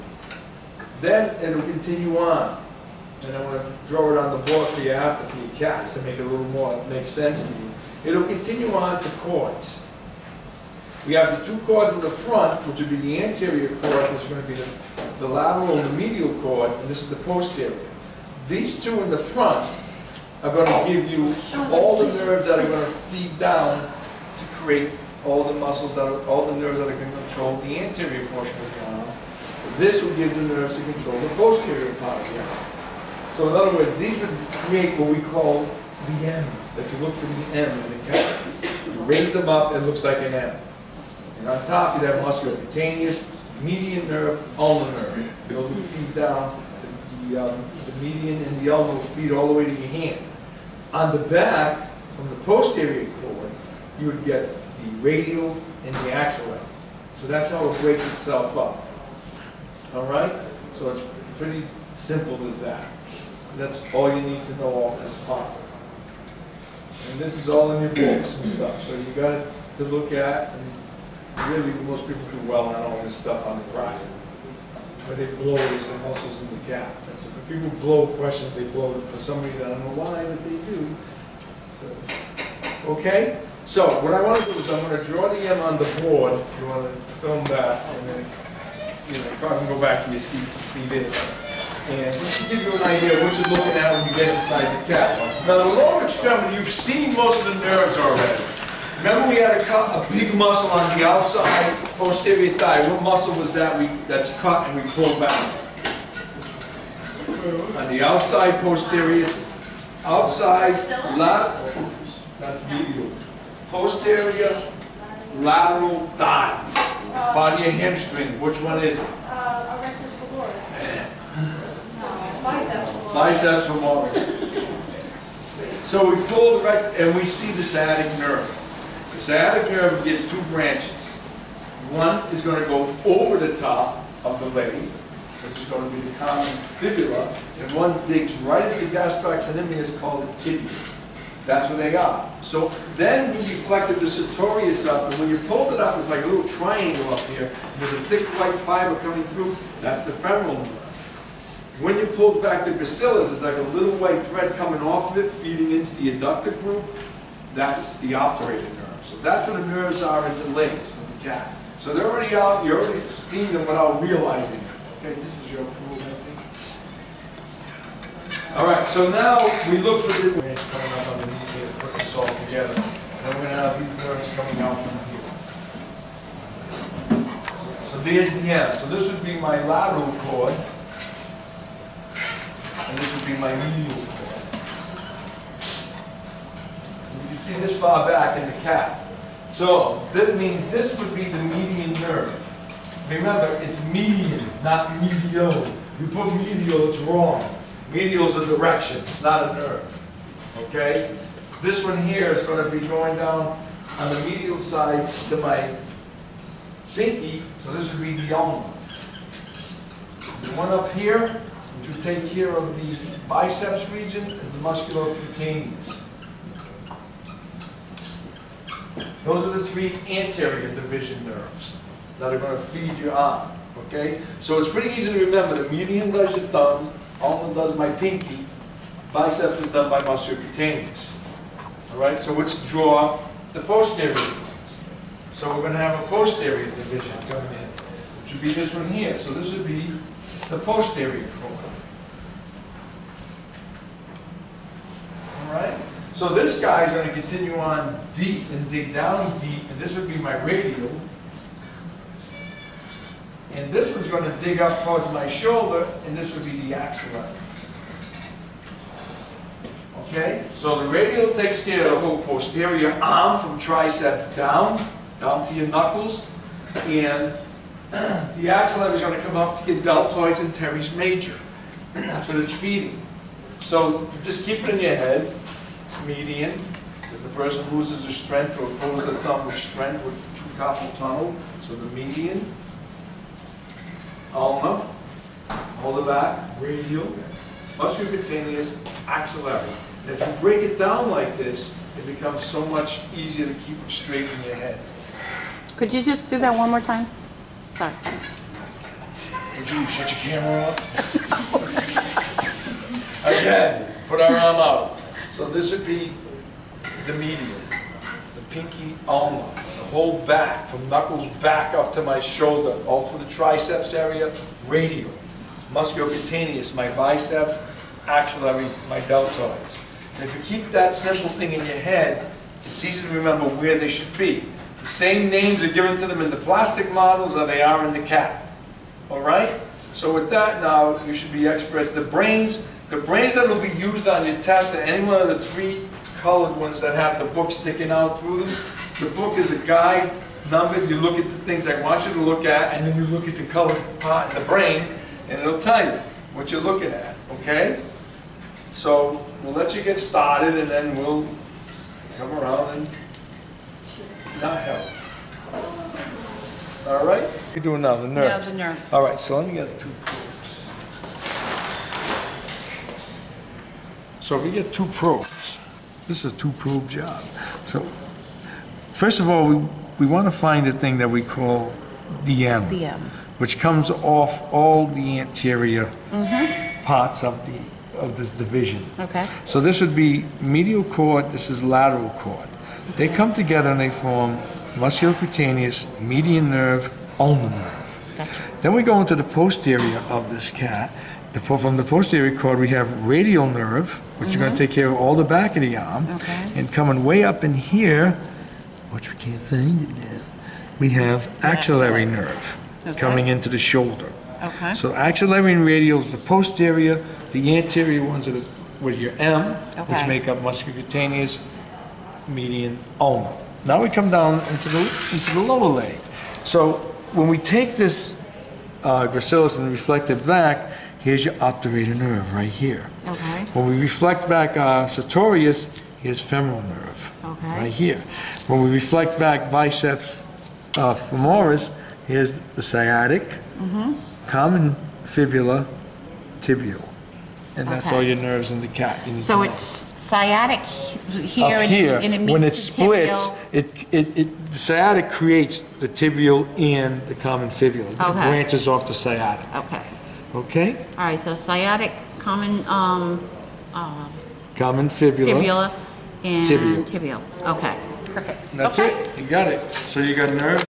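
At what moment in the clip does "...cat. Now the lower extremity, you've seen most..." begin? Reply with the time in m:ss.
1:34.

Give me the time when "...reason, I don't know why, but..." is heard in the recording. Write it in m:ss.
1:19.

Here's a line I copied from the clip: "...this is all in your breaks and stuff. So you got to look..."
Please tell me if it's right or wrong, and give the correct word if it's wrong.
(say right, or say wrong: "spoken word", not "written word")
wrong: "books", not "breaks".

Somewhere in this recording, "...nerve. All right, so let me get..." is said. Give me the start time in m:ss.
5:58.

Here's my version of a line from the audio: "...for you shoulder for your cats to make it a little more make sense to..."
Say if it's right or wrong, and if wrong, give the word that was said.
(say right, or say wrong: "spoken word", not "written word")
wrong: "after", not "shoulder".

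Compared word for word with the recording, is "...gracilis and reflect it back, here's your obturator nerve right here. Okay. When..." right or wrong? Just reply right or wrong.
right.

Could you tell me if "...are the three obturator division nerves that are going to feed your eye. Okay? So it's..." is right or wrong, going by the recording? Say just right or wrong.
wrong.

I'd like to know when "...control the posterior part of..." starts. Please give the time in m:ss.
0:30.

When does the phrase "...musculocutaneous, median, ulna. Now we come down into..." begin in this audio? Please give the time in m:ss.
6:50.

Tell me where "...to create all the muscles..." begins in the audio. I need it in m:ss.
0:24.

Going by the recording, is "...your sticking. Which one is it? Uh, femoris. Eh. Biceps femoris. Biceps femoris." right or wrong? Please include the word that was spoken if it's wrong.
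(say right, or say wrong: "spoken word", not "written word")
wrong: "hamstring", not "sticking".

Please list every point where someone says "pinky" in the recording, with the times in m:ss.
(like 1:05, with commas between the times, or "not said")
3:26, 3:47, 5:08.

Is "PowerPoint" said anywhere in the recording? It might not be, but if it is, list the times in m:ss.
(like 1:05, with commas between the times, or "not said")
not said.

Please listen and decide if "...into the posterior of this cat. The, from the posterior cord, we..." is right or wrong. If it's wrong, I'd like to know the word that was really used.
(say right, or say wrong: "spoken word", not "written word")
right.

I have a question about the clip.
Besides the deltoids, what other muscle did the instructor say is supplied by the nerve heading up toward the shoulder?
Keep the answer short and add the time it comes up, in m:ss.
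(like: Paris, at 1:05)
Teres major, at 4:30.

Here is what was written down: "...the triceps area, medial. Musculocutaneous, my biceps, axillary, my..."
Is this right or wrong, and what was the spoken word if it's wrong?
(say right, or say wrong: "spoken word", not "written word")
wrong: "radial", not "medial".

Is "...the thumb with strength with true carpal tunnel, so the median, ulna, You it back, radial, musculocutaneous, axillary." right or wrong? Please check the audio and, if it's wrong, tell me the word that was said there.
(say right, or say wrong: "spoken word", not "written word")
wrong: "Hold", not "You".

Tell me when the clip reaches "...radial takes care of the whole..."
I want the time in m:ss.
4:20.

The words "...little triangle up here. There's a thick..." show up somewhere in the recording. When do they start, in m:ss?
2:26.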